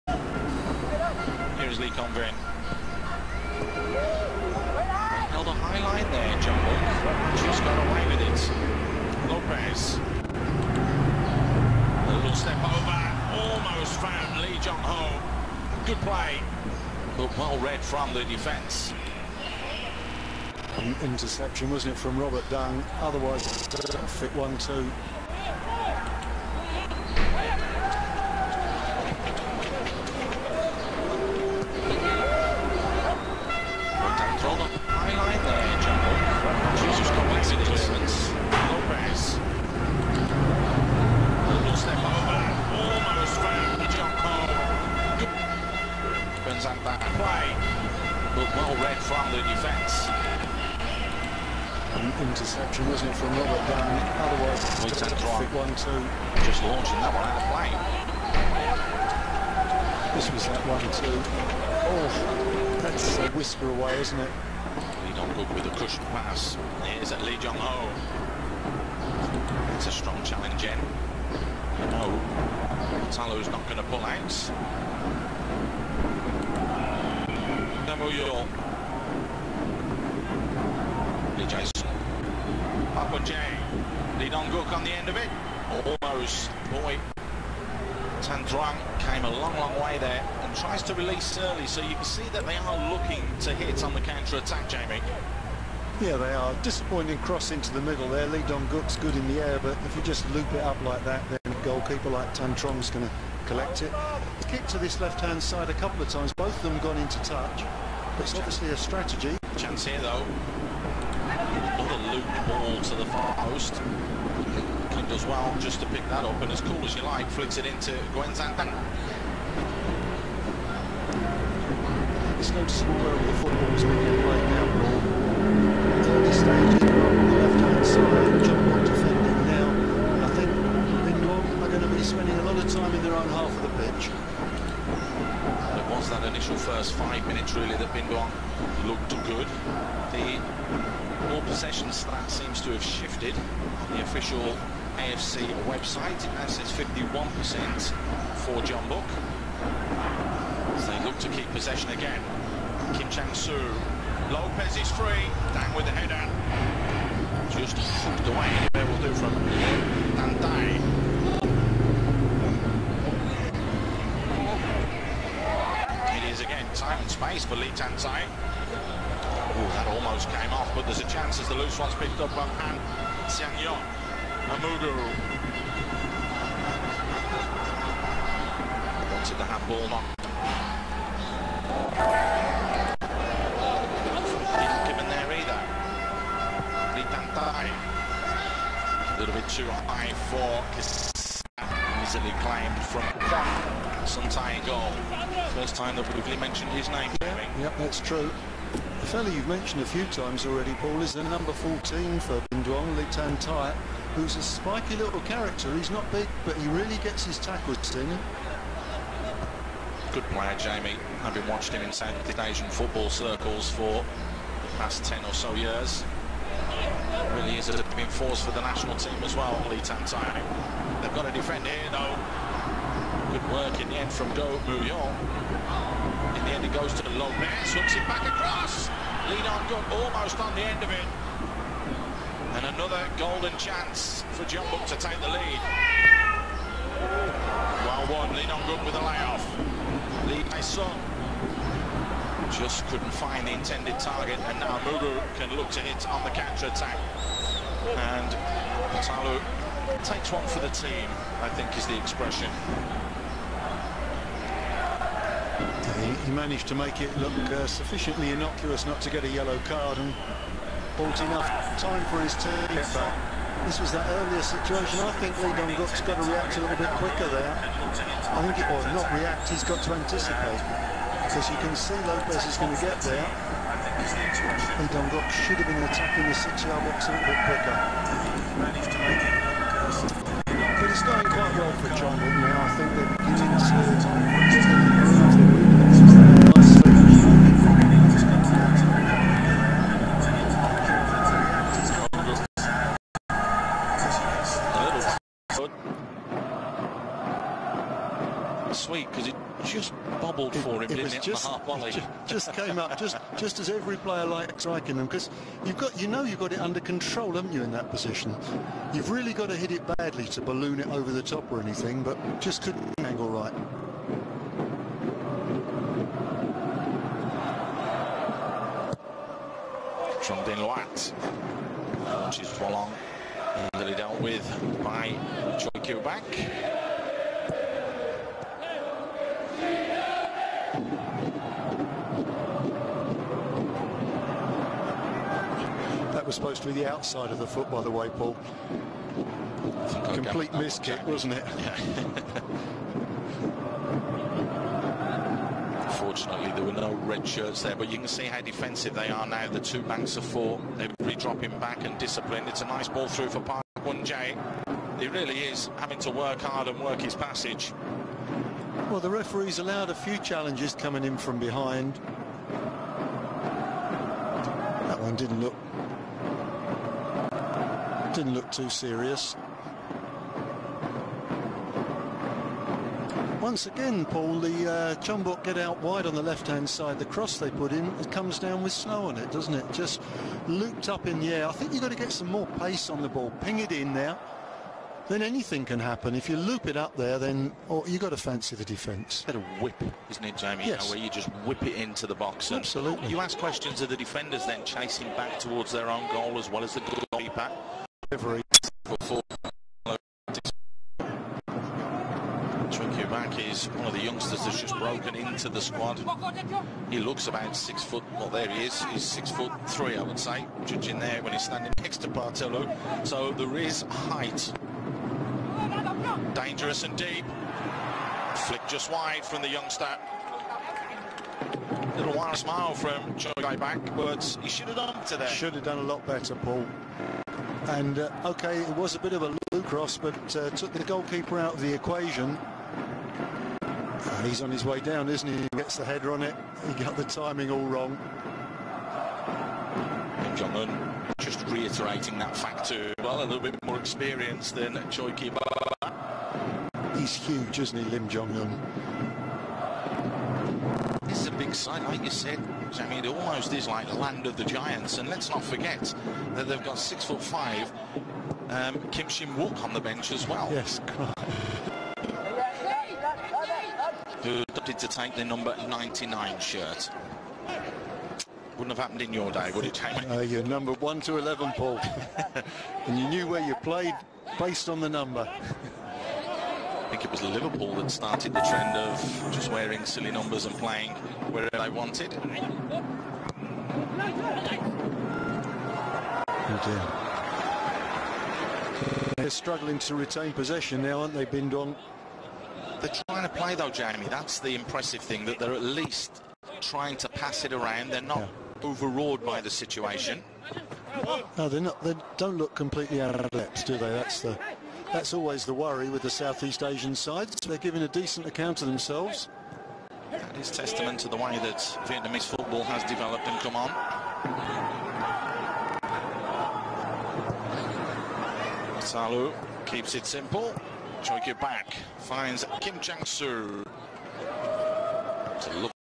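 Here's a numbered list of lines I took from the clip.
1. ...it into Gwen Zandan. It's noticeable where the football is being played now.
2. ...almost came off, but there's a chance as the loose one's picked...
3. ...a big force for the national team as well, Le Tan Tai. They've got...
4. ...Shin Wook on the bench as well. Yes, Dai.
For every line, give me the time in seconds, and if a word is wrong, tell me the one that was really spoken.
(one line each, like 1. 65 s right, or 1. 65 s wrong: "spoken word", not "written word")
1. 117 s right
2. 169 s right
3. 217 s right
4. 459 s wrong: "God", not "Dai".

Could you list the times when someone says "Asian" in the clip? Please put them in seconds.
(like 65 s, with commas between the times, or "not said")
212 s, 506 s.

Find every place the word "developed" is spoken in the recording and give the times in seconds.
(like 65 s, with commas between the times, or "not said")
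512 s.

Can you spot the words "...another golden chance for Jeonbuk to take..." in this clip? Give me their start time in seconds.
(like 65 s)
232 s.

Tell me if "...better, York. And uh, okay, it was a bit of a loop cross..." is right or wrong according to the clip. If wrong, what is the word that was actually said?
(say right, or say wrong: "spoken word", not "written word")
wrong: "Paul", not "York".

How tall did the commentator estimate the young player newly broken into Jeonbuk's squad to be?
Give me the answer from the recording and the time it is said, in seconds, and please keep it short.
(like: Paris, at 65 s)
six foot three, at 409 s.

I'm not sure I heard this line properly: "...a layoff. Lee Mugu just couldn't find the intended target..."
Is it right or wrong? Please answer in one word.
wrong.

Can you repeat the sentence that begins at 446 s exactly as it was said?
He's huge, isn't he, Lim Jong-eun?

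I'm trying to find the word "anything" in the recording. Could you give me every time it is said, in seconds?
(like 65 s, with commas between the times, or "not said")
311 s, 385 s.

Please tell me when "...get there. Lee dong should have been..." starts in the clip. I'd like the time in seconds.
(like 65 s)
272 s.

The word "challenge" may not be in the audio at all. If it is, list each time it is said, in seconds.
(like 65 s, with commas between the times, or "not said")
70 s, 360 s.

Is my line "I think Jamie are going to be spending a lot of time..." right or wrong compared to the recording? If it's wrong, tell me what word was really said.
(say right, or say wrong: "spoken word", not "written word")
wrong: "England", not "Jamie".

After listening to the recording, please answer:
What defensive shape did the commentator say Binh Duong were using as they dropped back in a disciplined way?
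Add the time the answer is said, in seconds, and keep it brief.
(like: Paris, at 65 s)
two banks of four, at 349 s.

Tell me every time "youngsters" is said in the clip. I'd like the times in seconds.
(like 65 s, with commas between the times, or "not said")
404 s, 419 s.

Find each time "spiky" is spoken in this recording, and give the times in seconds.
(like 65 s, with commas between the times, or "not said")
204 s.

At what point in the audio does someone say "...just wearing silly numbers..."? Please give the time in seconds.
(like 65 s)
479 s.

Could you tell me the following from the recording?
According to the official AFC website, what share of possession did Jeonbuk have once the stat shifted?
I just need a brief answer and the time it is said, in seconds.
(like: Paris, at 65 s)
51%, at 146 s.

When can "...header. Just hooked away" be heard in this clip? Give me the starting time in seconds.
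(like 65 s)
155 s.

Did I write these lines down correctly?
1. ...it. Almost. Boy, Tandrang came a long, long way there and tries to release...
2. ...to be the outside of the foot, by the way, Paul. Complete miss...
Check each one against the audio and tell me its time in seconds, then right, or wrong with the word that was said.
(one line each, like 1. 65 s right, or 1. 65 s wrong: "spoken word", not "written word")
1. 85 s right
2. 336 s right.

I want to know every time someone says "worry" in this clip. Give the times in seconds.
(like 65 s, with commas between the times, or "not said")
505 s.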